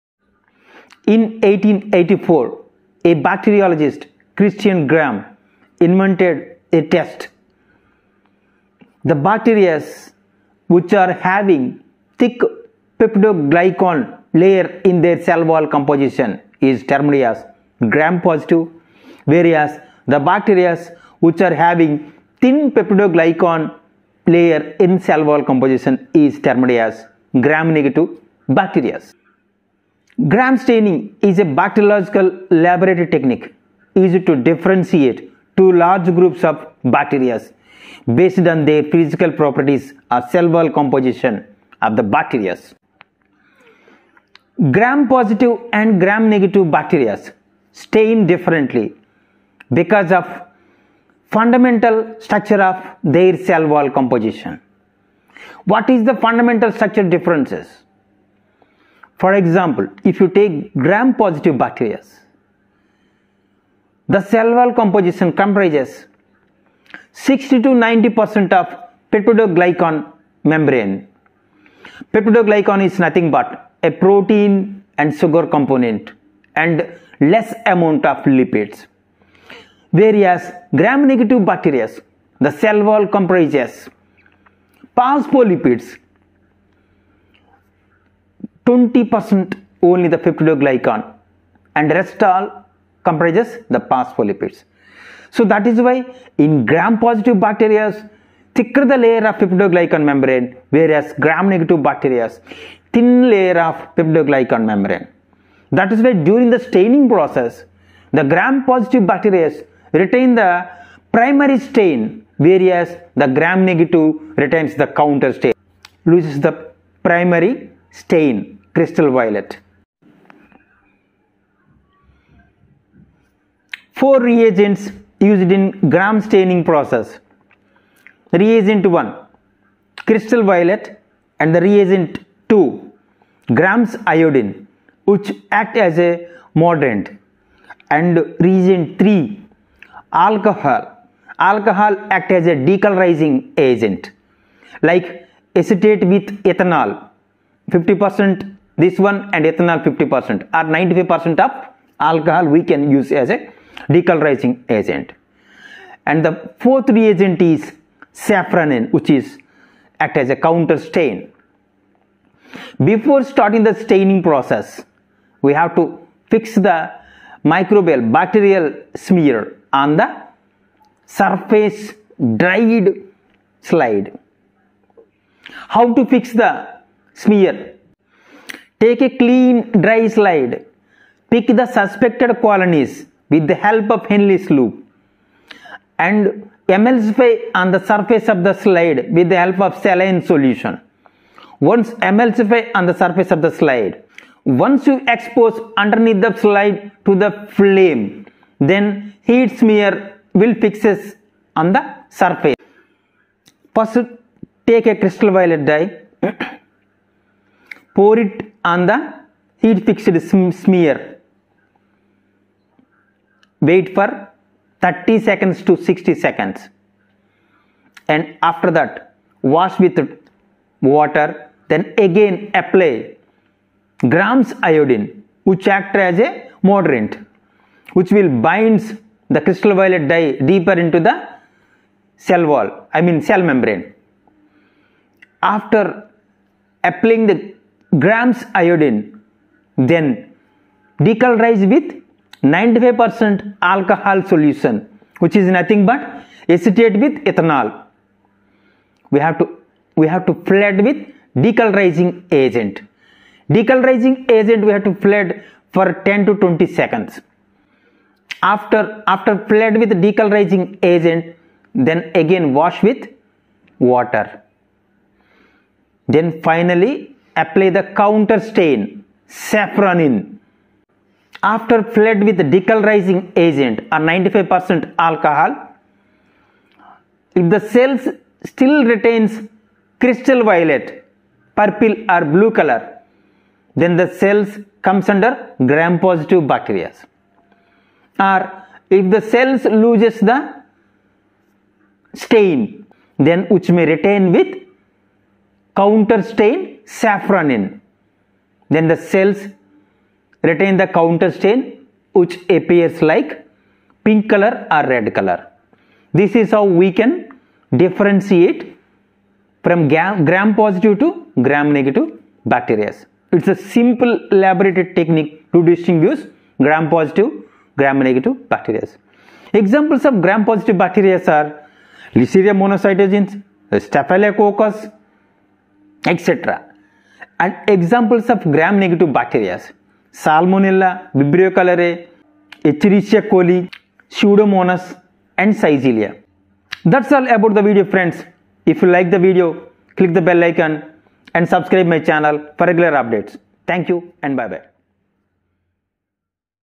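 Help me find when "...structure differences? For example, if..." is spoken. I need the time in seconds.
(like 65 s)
56 s.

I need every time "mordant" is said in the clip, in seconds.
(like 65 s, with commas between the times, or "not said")
136 s, 226 s.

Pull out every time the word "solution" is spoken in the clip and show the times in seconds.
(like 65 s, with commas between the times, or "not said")
190 s, 244 s.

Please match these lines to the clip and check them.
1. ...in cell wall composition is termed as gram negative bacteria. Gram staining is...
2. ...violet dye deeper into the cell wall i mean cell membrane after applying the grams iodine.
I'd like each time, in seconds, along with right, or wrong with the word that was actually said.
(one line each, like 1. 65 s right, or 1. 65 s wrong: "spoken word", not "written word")
1. 24 s right
2. 229 s right.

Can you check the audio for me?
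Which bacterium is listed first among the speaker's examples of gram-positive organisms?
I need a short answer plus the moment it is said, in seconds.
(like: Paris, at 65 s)
Listeria monocytogenes, at 322 s.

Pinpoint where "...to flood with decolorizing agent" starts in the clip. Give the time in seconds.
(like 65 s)
250 s.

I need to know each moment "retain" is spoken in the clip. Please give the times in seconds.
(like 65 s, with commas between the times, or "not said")
109 s, 114 s, 278 s, 293 s, 300 s.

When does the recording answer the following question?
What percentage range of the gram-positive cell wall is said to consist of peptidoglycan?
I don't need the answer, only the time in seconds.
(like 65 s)
67 s.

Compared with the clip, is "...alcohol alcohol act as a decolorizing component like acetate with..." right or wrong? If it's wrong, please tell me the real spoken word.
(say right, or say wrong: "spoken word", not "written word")
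wrong: "agent", not "component".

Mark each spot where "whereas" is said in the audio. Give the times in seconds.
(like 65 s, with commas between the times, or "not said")
19 s, 79 s, 100 s, 112 s.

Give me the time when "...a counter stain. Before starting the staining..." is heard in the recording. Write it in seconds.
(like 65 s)
160 s.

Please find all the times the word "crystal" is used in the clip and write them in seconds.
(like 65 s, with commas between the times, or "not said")
118 s, 130 s, 204 s, 229 s, 280 s.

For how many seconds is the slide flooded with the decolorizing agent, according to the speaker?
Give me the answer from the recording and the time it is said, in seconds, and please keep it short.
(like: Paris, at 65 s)
10 to 20 seconds, at 256 s.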